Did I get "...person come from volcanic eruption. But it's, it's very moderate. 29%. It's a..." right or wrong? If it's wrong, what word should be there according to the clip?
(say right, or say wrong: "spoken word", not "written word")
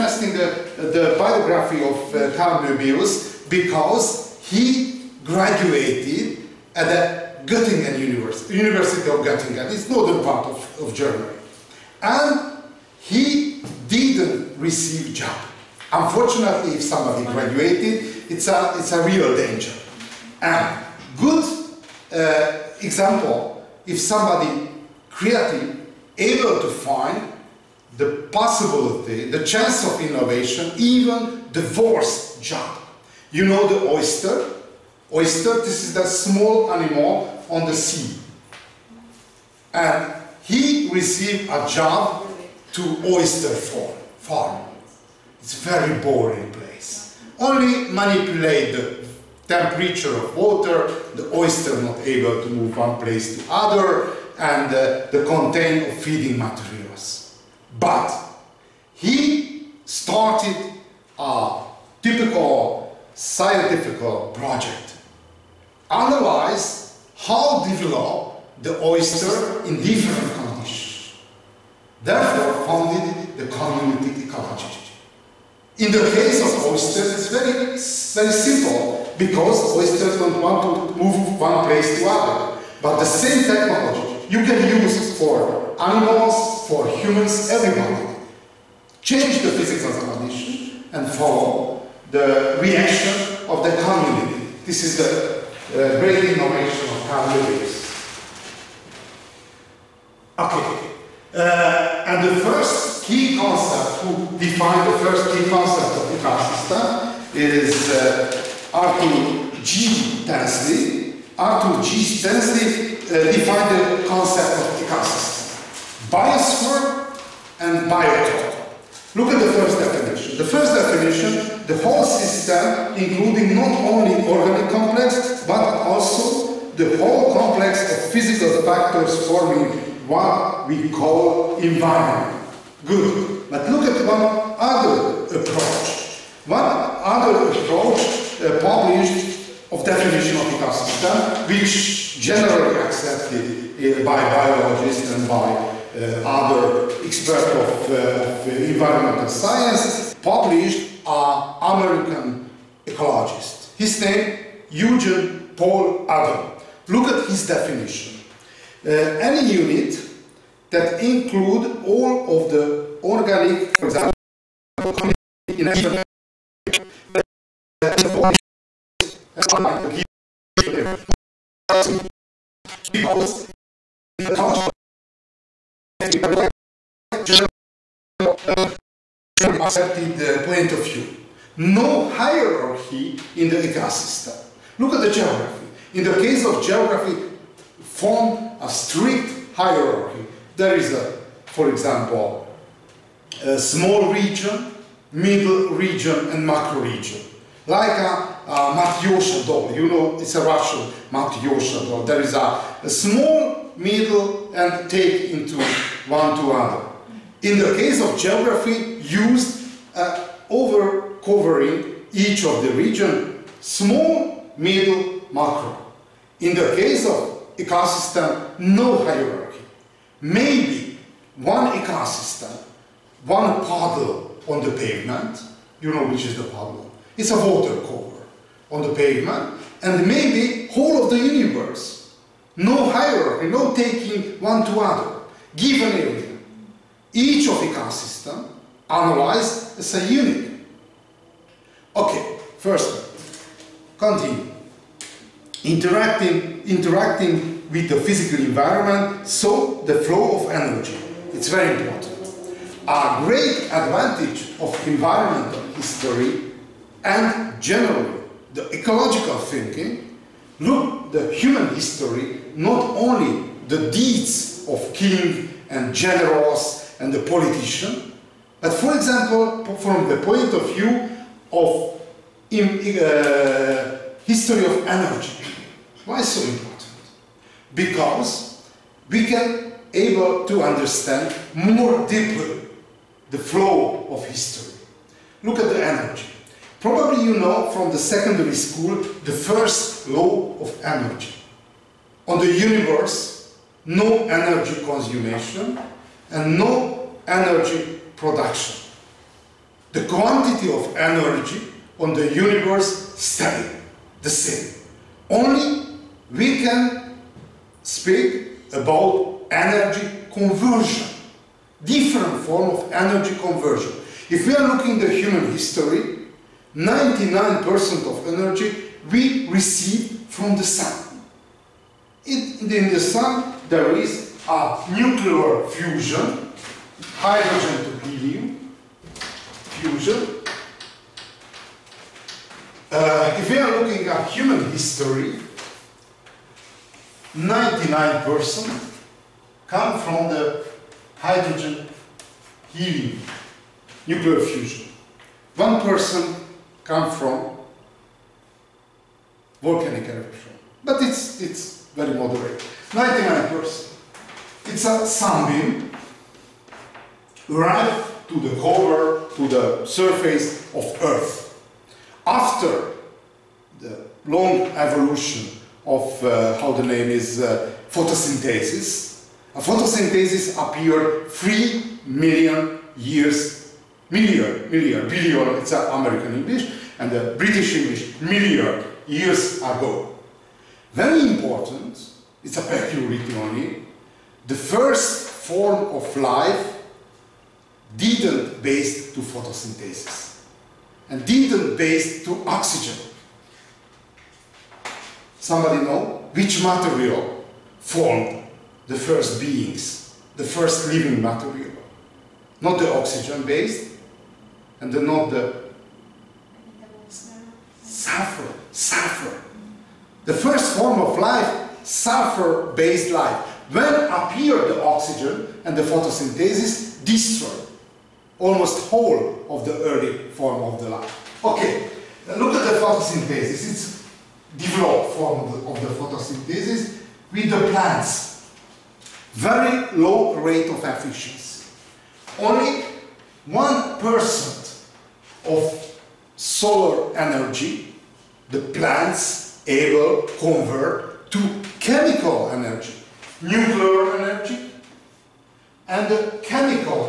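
wrong: "99", not "29".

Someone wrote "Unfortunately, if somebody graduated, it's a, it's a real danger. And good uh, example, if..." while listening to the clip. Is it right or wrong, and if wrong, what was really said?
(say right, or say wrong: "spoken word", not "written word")
right.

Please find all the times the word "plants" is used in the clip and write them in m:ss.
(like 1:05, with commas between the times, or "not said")
7:07, 7:18.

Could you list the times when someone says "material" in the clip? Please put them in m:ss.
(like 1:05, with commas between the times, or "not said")
0:56, 6:36, 6:41.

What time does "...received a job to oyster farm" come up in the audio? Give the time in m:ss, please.
0:40.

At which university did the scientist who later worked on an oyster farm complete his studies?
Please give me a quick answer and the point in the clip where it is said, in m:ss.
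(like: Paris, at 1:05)
University of Göttingen, at 0:08.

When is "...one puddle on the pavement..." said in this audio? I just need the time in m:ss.
3:43.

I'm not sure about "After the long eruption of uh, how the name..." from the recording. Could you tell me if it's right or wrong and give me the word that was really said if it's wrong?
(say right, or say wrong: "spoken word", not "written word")
wrong: "evolution", not "eruption".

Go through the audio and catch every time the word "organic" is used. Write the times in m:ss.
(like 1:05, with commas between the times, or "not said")
2:04, 2:43.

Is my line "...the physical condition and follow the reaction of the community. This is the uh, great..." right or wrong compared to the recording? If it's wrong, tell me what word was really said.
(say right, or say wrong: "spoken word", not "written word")
right.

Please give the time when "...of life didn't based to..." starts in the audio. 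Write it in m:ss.
6:25.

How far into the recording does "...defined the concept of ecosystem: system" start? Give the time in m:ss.
1:53.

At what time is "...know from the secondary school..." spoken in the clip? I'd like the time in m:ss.
4:47.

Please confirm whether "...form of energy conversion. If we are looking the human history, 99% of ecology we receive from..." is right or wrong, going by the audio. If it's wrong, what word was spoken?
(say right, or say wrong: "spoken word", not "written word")
wrong: "energy", not "ecology".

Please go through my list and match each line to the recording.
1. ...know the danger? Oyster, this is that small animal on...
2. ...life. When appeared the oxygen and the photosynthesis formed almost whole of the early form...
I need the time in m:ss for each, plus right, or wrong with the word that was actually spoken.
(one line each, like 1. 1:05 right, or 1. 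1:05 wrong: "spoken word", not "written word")
1. 0:33 wrong: "oyster", not "danger"
2. 6:53 wrong: "destroyed", not "formed".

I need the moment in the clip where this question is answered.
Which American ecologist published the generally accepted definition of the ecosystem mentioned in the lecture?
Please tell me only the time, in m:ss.
2:34.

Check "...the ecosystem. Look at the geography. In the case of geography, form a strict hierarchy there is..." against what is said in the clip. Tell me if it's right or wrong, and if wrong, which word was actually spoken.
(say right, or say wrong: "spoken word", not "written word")
right.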